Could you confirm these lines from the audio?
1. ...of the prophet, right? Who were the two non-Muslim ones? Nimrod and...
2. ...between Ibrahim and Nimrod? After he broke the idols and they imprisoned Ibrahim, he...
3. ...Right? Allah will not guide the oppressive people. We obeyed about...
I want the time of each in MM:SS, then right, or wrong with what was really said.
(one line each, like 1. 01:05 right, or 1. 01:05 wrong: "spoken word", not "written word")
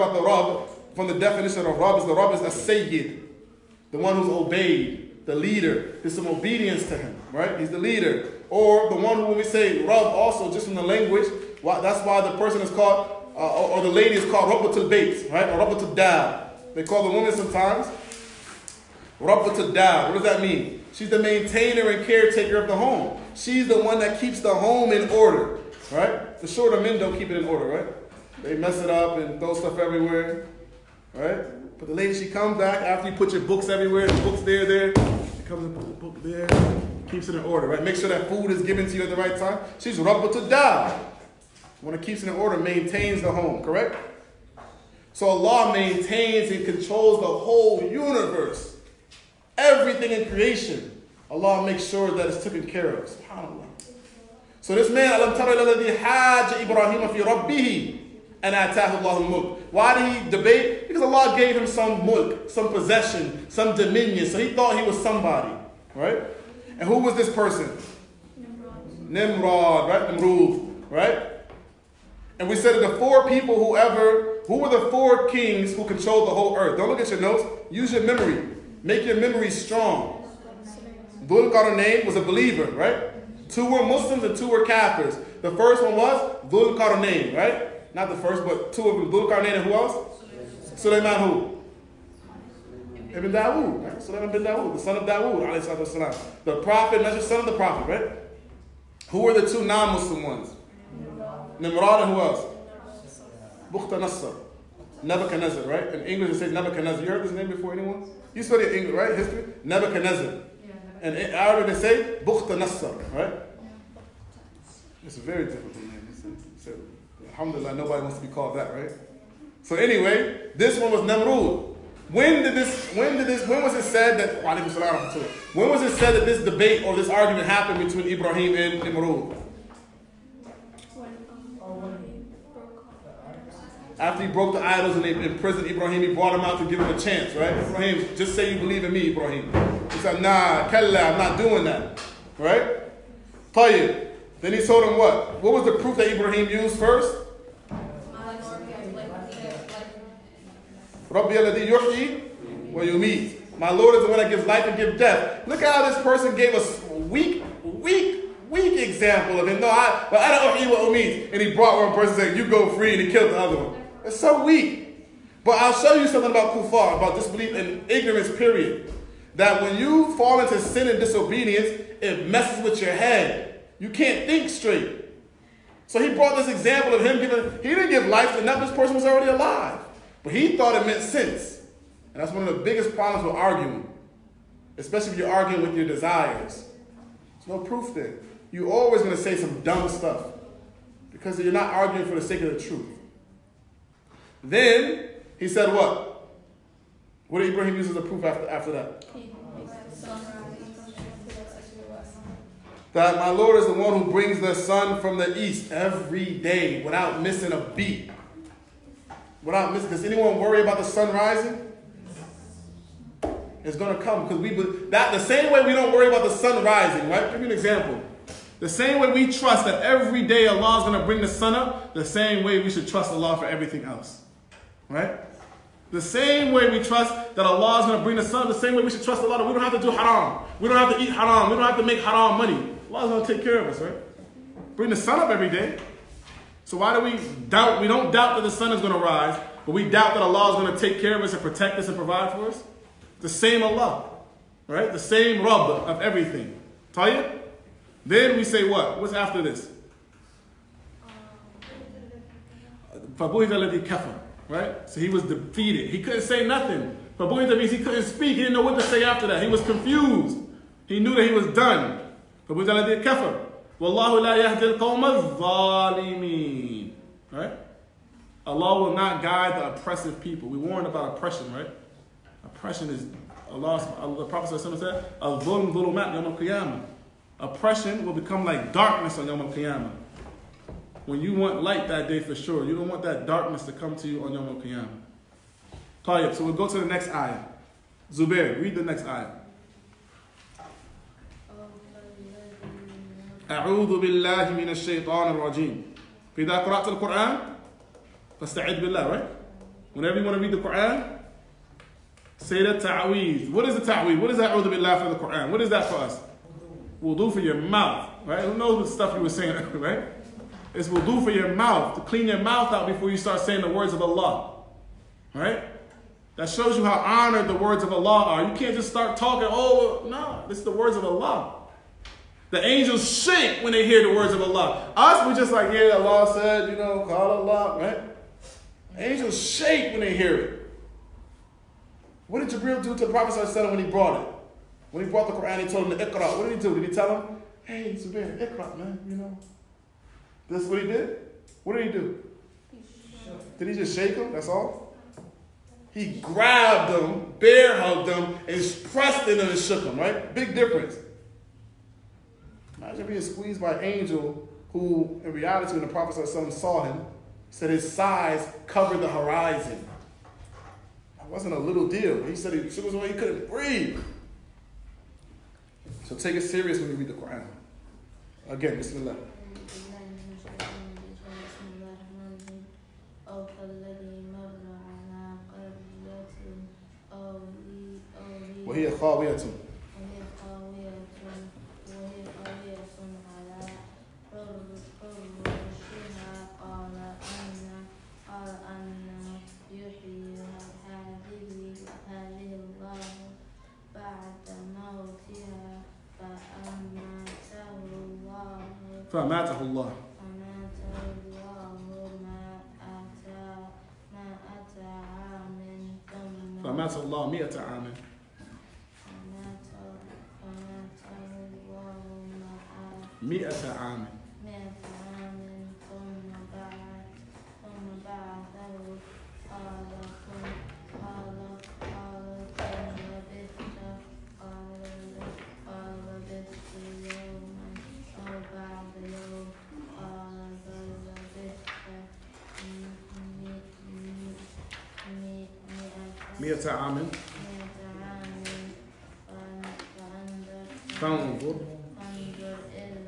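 1. 01:37 right
2. 02:07 wrong: "Namrud", not "Nimrod"
3. 04:27 wrong: "warned", not "obeyed".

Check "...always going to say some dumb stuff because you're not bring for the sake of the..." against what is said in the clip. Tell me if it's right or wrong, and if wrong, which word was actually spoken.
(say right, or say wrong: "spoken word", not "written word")
wrong: "arguing", not "bring".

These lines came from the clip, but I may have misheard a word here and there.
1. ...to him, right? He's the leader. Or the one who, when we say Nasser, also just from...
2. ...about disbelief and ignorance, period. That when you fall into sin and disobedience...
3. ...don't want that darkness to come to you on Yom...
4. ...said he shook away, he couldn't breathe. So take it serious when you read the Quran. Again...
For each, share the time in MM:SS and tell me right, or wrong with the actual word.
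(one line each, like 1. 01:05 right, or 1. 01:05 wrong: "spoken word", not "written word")
1. 00:06 wrong: "Rab", not "Nasser"
2. 02:46 right
3. 04:42 right
4. 06:02 right.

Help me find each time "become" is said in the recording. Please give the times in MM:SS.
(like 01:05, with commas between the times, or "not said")
04:38.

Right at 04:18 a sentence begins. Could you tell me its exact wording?
He didn't know what to say after that.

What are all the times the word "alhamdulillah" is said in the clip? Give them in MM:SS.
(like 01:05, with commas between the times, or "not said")
01:57.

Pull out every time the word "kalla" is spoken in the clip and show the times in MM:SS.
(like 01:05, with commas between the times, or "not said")
02:20.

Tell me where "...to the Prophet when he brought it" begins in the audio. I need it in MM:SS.
05:32.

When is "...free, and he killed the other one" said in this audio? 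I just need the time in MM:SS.
02:42.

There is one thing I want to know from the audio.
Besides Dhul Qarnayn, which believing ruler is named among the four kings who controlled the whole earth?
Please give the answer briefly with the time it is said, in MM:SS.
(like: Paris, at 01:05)
Sulaiman bin Dawood, at 01:33.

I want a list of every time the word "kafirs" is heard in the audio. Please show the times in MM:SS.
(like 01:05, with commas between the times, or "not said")
01:24, 04:23.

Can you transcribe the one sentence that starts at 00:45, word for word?
So Allah maintains and controls the whole universe.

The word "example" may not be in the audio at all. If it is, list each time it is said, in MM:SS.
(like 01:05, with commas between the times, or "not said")
02:38, 02:56, 03:37.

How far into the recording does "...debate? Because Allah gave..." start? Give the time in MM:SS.
01:00.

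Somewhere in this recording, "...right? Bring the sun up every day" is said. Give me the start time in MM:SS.
03:53.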